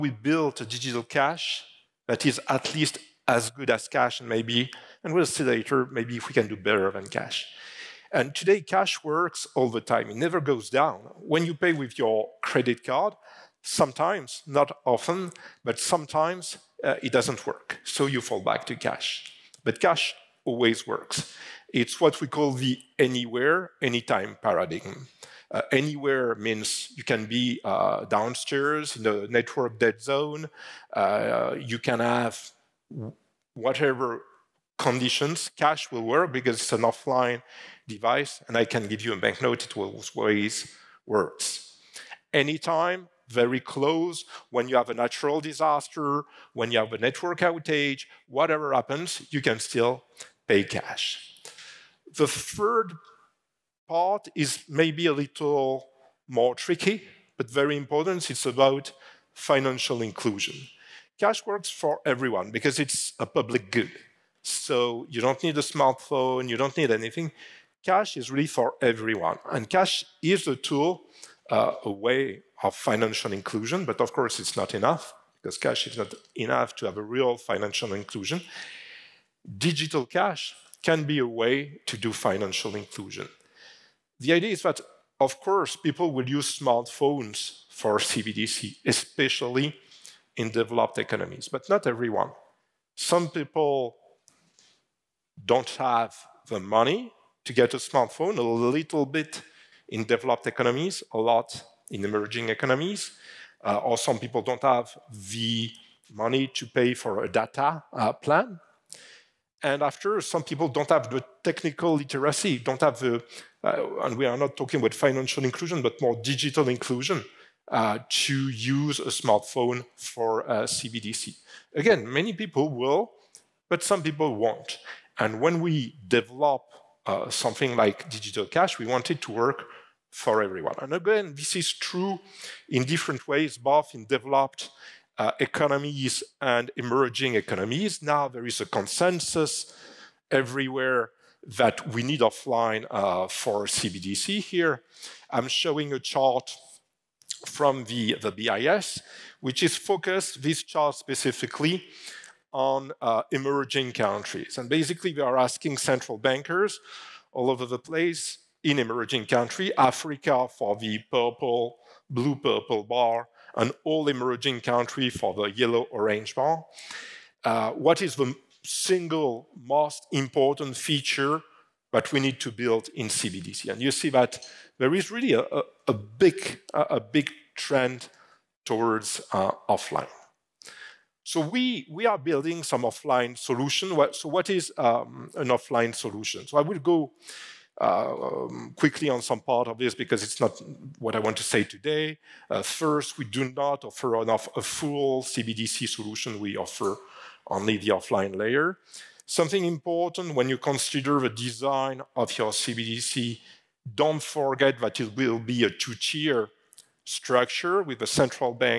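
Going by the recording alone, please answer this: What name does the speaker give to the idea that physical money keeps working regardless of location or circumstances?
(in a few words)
anywhere, anytime paradigm.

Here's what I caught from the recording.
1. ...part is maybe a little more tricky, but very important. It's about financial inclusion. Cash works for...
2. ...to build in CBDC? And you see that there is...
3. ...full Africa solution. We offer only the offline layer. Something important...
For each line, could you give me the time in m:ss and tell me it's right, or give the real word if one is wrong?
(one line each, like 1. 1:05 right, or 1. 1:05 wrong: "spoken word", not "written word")
1. 0:53 right
2. 2:52 right
3. 3:14 wrong: "CBDC", not "Africa".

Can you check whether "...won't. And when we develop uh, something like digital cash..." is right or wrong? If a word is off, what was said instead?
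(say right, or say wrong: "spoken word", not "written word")
right.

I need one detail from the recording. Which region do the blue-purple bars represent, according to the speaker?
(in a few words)
Africa.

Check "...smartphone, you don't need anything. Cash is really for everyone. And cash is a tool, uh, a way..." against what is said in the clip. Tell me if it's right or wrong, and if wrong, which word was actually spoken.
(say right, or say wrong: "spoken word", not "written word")
right.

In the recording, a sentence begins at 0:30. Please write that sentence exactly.
Uh, you can have whatever conditions.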